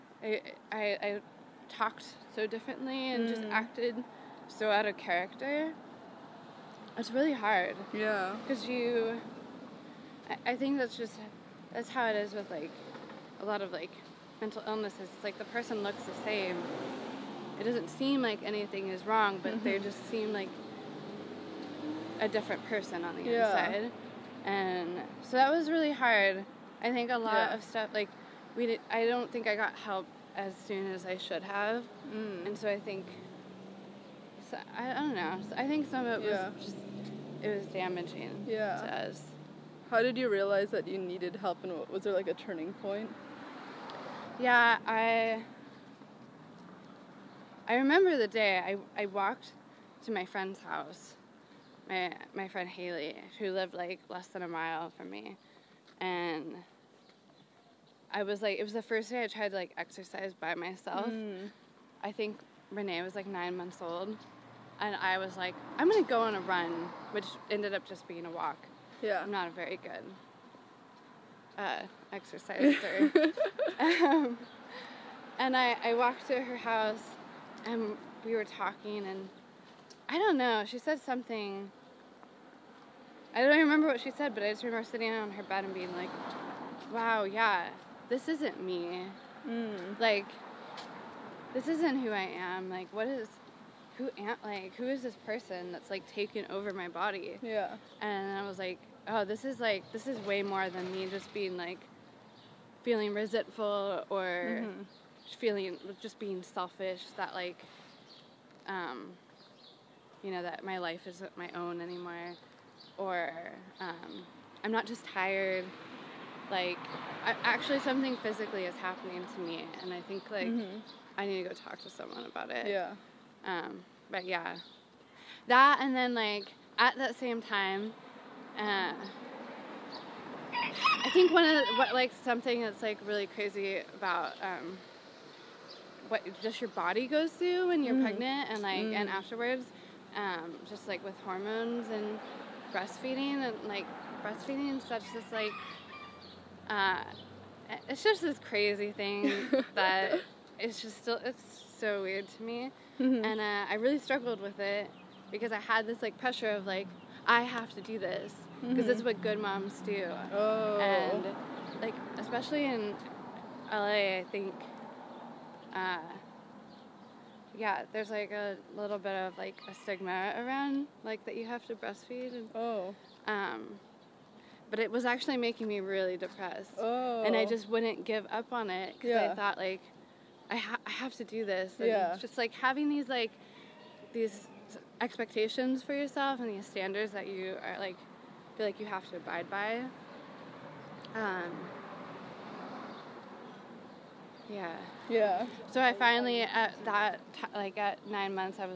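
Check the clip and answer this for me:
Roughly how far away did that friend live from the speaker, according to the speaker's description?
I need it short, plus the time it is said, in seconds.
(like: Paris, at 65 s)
Less than a mile, at 54 s.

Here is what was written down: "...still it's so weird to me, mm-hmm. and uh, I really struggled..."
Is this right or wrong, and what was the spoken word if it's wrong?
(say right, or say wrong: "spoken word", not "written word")
right.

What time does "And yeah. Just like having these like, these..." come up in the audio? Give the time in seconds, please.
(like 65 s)
181 s.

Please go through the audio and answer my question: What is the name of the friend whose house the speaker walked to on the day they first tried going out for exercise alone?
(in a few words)
Haley.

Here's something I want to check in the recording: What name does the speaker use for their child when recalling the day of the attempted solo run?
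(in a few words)
Renee.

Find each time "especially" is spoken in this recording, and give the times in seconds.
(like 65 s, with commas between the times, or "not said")
162 s.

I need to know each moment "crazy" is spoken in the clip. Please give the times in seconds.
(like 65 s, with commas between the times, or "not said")
133 s, 148 s.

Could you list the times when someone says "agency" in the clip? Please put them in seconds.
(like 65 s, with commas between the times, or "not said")
not said.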